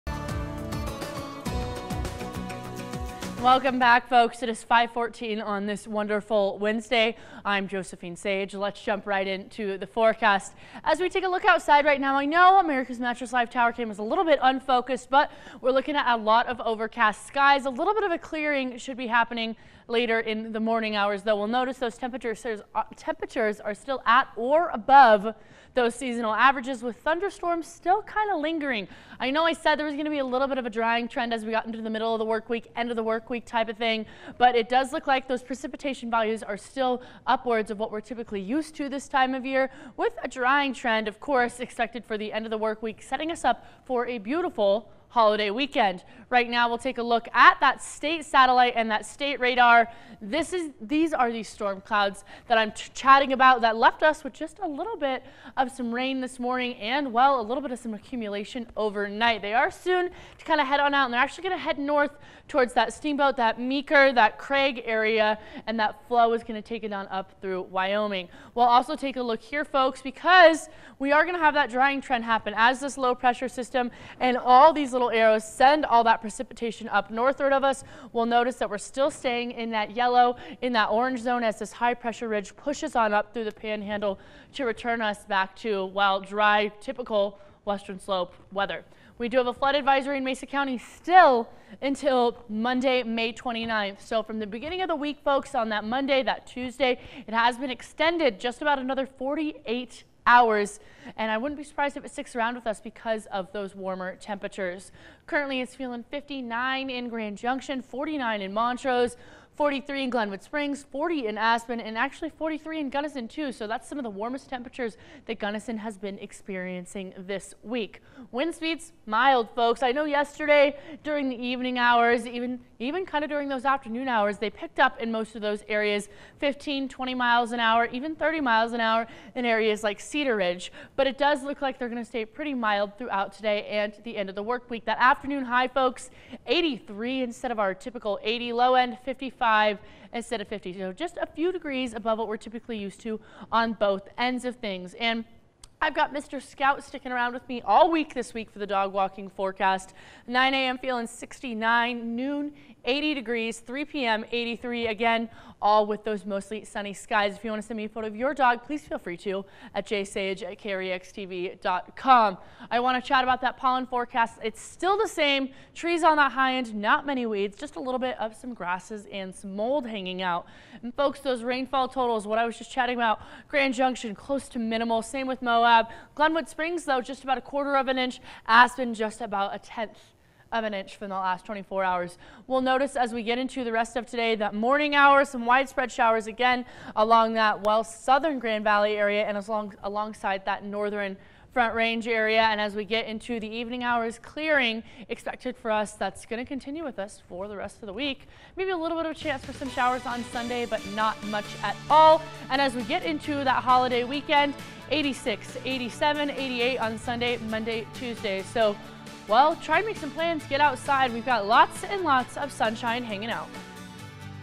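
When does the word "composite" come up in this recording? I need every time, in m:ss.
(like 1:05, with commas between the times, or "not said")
not said.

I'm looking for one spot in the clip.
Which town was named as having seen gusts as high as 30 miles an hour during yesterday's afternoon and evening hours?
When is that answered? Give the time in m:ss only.
2:09.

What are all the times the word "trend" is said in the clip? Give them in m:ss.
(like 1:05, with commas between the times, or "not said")
0:31, 0:40, 1:11.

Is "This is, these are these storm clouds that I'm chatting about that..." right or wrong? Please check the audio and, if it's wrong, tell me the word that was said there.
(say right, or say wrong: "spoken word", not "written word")
right.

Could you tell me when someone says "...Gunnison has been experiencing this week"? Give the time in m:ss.
1:55.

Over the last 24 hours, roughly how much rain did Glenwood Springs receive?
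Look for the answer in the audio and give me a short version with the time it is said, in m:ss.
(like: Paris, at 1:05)
a quarter of an inch, at 2:57.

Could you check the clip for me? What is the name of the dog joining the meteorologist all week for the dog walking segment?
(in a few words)
Scout.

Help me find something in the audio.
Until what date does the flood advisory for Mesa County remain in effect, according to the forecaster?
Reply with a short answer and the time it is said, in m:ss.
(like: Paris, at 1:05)
Monday, May 29th, at 1:32.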